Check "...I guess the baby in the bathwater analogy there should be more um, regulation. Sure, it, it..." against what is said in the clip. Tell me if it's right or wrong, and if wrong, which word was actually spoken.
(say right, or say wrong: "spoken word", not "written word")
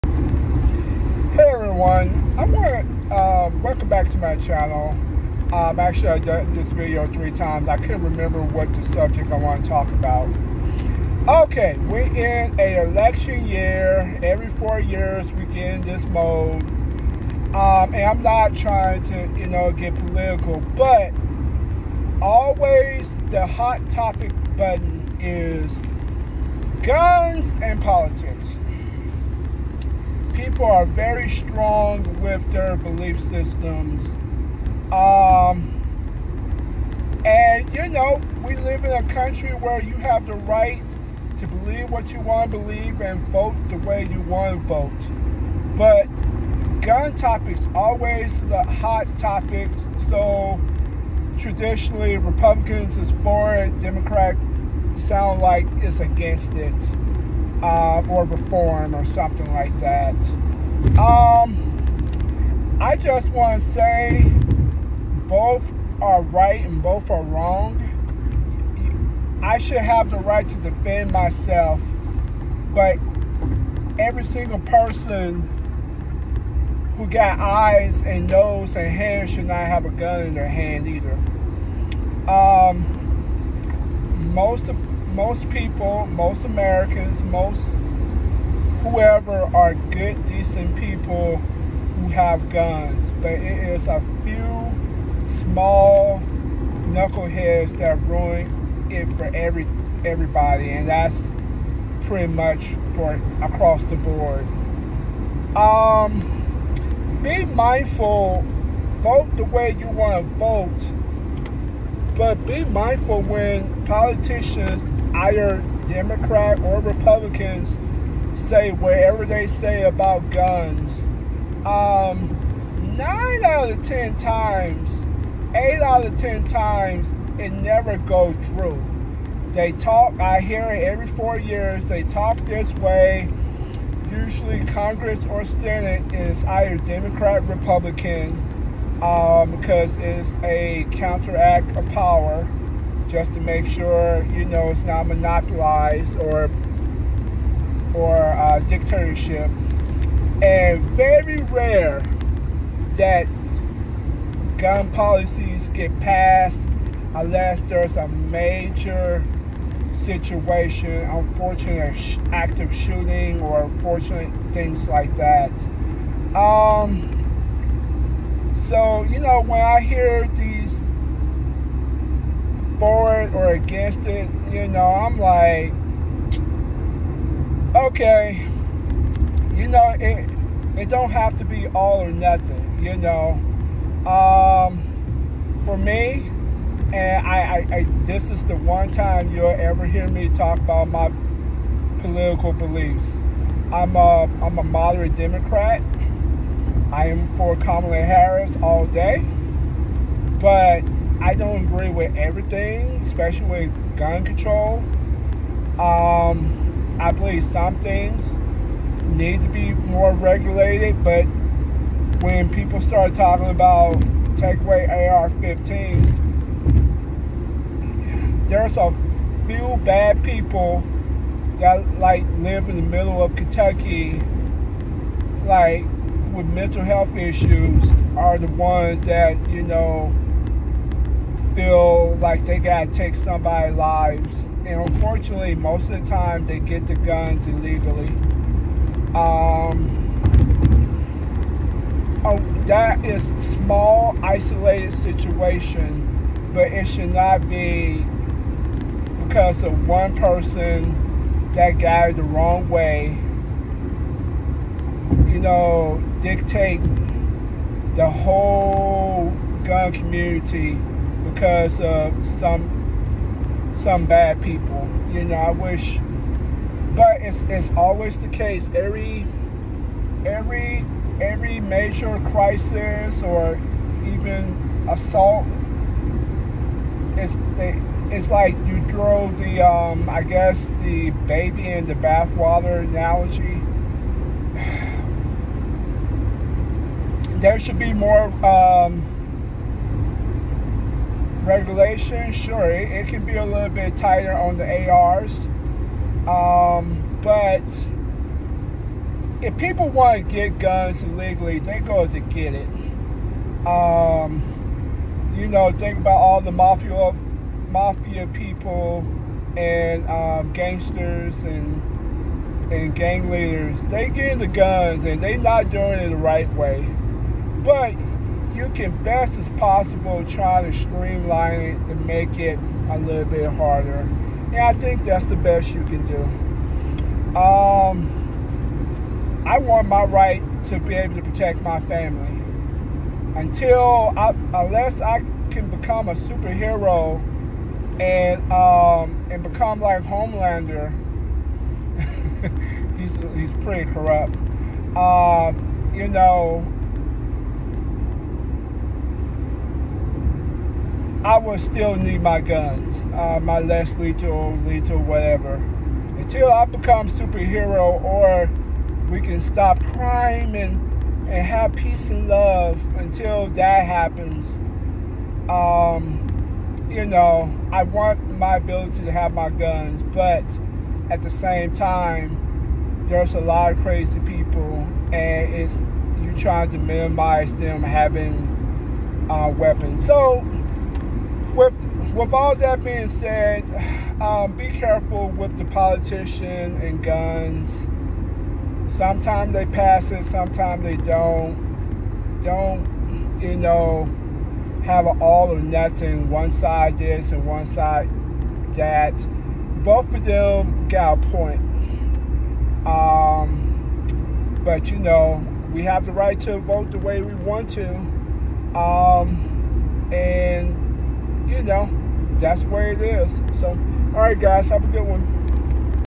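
right.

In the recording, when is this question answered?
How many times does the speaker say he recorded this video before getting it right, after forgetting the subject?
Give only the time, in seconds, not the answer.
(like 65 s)
7 s.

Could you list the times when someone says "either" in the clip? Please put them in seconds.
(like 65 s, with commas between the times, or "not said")
80 s, 115 s, 136 s.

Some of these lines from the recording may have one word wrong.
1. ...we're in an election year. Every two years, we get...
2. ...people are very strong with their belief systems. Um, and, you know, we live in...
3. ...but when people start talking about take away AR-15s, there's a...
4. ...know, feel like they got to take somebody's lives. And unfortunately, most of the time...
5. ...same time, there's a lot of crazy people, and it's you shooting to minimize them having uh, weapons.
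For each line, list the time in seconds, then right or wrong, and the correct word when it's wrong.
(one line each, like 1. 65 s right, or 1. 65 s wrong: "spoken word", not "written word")
1. 11 s wrong: "four", not "two"
2. 30 s right
3. 211 s right
4. 229 s right
5. 371 s wrong: "trying", not "shooting".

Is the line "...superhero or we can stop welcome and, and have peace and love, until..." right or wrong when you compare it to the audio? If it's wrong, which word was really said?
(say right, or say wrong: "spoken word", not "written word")
wrong: "crime", not "welcome".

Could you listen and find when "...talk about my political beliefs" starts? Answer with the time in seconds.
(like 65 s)
190 s.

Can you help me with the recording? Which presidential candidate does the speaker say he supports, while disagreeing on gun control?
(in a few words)
Kamala Harris.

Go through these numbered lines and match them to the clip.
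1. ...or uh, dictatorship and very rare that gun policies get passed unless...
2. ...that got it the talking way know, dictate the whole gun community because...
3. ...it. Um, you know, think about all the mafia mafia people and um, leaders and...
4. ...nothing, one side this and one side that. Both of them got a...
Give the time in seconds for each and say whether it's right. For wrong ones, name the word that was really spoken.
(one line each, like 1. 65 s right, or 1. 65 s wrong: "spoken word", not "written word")
1. 147 s right
2. 251 s wrong: "wrong", not "talking"
3. 302 s wrong: "gangsters", not "leaders"
4. 395 s right.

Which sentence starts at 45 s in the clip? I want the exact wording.
But gun topics always is a hot topic.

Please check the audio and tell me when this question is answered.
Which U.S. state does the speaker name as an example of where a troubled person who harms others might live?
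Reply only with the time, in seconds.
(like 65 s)
223 s.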